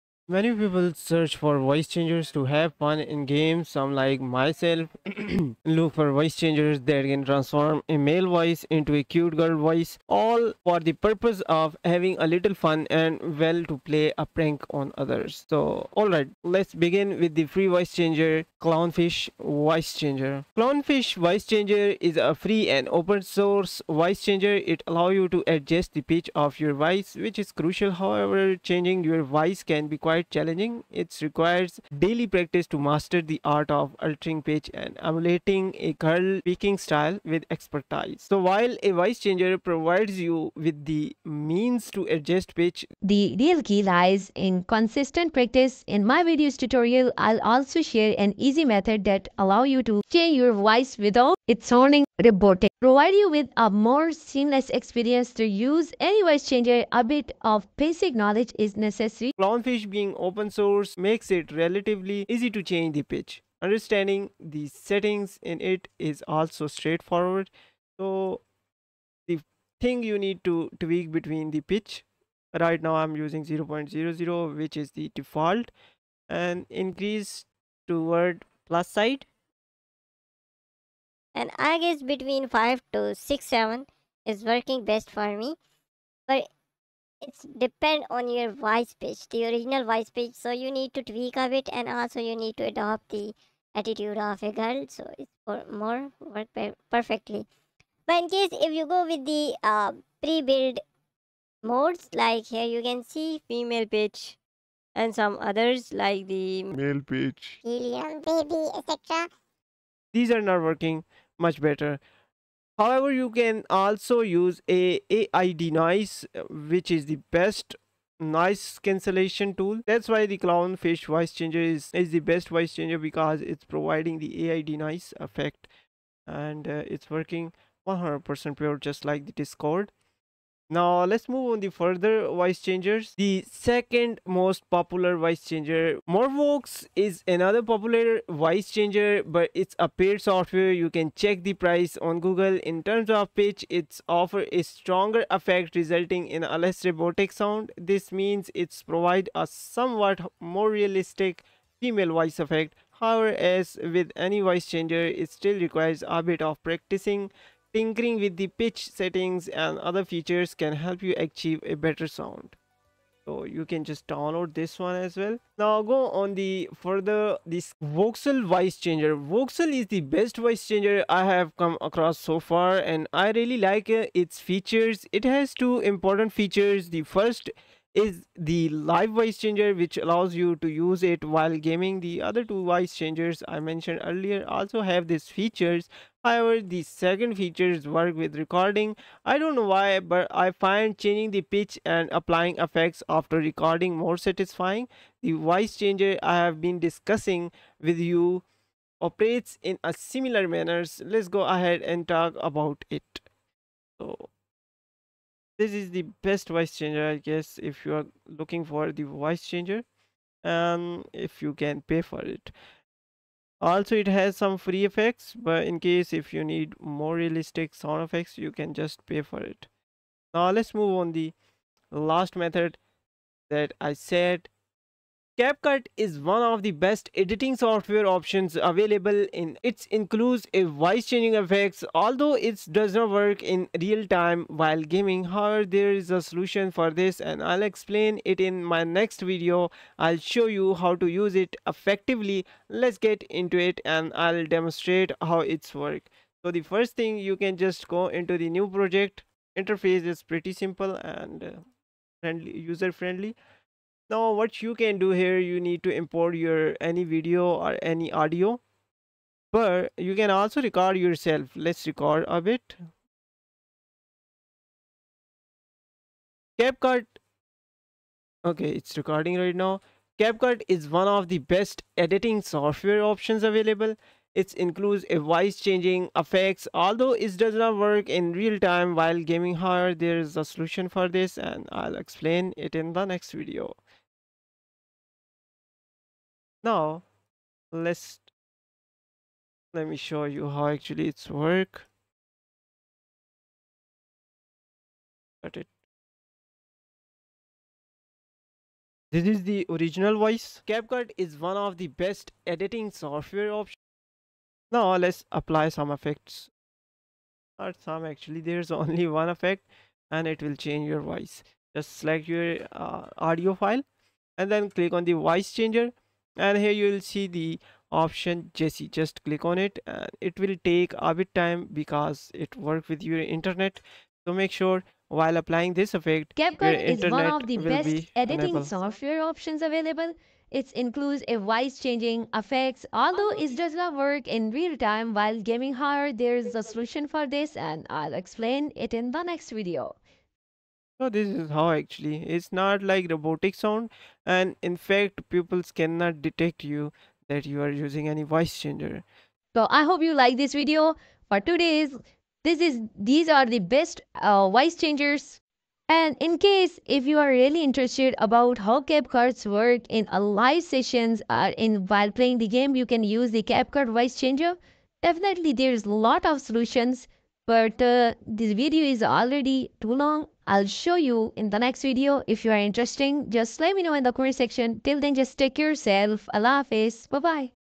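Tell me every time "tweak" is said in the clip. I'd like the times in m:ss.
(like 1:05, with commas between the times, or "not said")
1:10, 1:31.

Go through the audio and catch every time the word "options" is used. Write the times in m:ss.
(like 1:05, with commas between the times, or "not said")
3:48, 4:33, 5:03, 5:17, 5:29.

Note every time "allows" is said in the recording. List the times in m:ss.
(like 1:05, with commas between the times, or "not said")
0:24, 0:49, 2:59.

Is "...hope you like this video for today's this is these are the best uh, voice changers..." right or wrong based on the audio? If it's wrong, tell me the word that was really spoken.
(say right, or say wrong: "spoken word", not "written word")
right.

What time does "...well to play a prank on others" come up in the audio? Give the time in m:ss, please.
0:13.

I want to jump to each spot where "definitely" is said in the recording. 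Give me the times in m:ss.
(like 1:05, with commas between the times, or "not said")
6:05.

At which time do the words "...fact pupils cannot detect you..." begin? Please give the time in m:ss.
5:44.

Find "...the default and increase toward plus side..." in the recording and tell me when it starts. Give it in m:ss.
1:14.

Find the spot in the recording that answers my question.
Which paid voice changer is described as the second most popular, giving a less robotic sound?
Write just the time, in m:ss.
2:16.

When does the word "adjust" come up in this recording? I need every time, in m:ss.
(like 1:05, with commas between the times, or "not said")
0:25, 0:42.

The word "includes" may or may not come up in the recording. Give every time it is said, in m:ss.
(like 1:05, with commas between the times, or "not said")
3:49, 4:34, 5:30.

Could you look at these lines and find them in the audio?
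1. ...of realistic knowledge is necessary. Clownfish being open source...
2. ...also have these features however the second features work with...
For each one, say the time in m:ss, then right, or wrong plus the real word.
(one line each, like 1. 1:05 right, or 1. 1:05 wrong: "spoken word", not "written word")
1. 0:57 wrong: "basic", not "realistic"
2. 3:04 right.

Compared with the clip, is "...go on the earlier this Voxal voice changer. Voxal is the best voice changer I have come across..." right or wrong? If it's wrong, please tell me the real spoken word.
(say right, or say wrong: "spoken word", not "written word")
wrong: "further", not "earlier".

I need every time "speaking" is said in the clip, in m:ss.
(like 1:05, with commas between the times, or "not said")
0:36.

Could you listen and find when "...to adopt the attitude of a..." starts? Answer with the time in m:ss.
1:32.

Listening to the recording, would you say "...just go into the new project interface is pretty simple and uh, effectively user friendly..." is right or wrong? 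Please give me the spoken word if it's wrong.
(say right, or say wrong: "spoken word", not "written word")
wrong: "friendly", not "effectively".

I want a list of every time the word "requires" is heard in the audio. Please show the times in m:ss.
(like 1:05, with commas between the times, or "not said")
0:31, 2:35.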